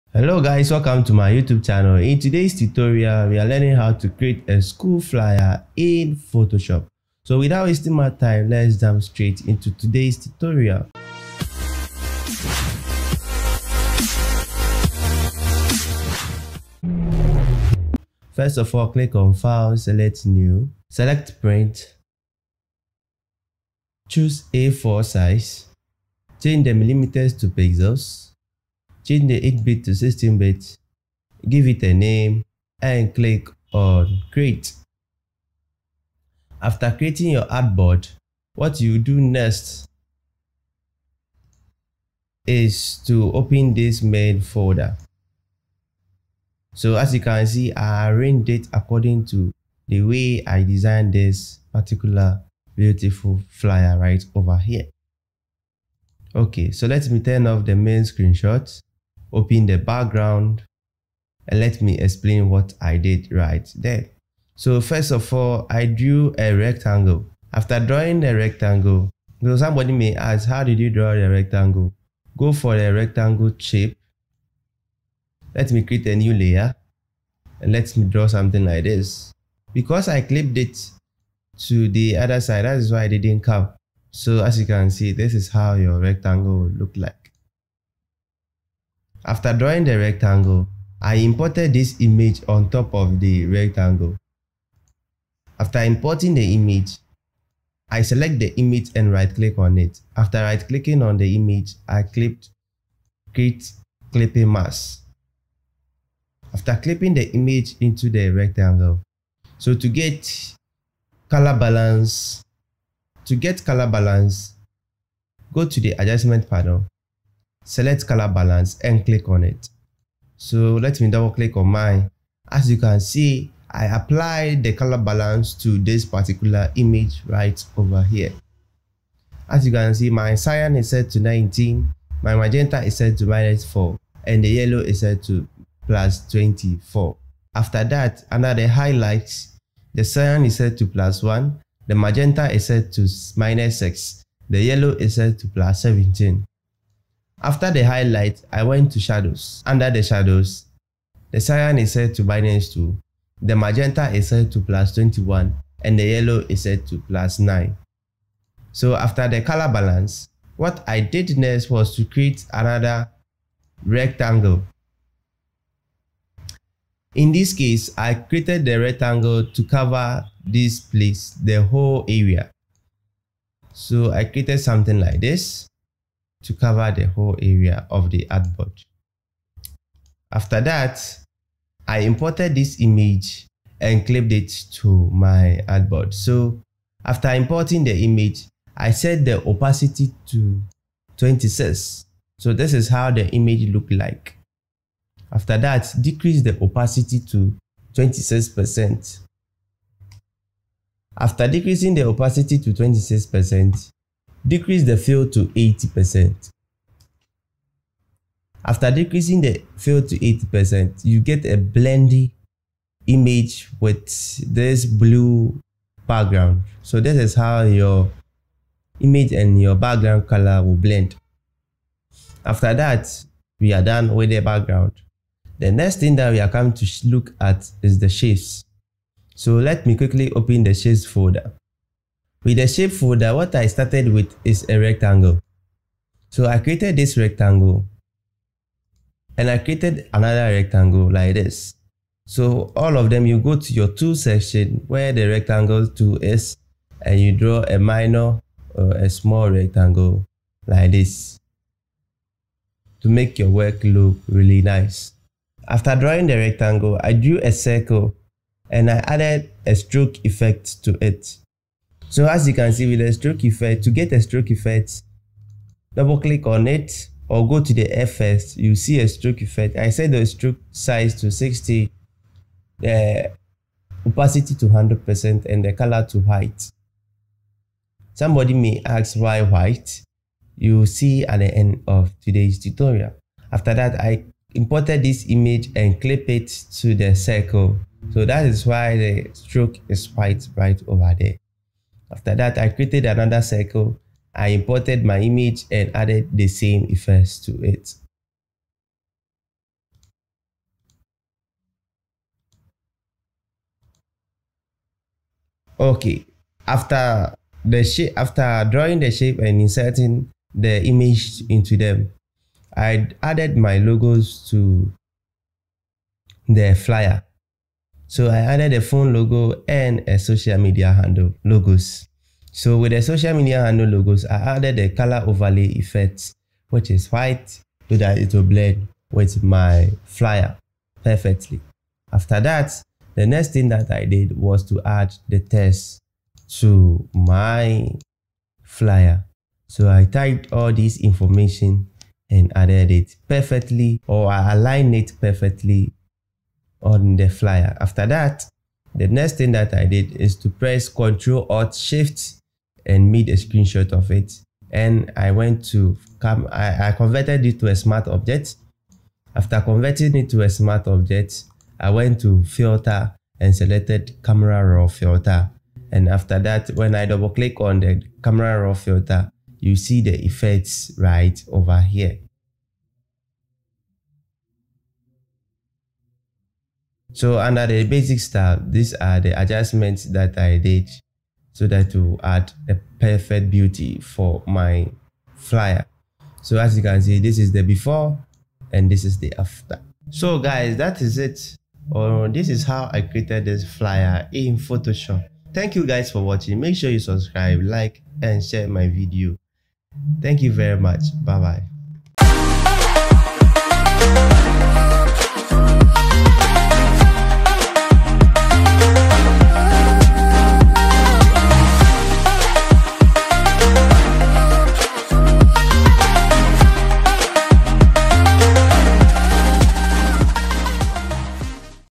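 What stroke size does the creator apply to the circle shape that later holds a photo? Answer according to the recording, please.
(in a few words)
60.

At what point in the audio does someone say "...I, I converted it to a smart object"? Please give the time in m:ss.
5:56.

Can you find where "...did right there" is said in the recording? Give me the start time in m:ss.
1:02.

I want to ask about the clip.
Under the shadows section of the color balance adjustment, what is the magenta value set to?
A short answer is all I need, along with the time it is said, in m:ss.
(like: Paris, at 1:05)
+21, at 2:34.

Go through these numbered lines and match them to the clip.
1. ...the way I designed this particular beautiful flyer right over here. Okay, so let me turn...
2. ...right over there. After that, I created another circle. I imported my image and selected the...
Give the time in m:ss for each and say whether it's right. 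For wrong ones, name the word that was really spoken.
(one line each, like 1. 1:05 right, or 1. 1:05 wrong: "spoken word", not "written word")
1. 0:49 right
2. 4:50 wrong: "added", not "selected".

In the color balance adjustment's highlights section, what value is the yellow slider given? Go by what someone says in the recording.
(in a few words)
+17.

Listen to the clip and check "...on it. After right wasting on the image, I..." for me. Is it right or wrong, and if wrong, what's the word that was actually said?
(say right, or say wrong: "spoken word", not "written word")
wrong: "clicking", not "wasting".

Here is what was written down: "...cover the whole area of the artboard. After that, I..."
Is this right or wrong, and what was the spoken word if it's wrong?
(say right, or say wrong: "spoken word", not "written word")
right.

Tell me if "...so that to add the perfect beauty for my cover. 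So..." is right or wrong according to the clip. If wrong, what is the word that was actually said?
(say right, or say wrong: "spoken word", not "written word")
wrong: "flyer", not "cover".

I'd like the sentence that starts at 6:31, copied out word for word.
Or this is how I created this flyer in Photoshop.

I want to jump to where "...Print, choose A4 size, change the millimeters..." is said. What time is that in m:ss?
0:21.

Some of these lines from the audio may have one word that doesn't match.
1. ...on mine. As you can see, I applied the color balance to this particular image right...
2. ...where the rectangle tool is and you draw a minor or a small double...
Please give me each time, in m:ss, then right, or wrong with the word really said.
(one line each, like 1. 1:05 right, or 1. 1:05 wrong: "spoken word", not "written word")
1. 2:01 right
2. 4:04 wrong: "rectangle", not "double".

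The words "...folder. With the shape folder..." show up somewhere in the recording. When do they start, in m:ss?
3:51.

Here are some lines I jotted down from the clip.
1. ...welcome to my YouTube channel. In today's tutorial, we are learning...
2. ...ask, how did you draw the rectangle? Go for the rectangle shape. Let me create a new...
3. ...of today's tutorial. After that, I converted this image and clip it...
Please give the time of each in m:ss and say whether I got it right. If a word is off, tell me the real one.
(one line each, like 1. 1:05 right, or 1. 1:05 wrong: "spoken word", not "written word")
1. 0:00 right
2. 1:10 right
3. 4:41 wrong: "imported", not "converted".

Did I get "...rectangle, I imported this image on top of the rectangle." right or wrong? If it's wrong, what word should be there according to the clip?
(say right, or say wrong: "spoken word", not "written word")
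right.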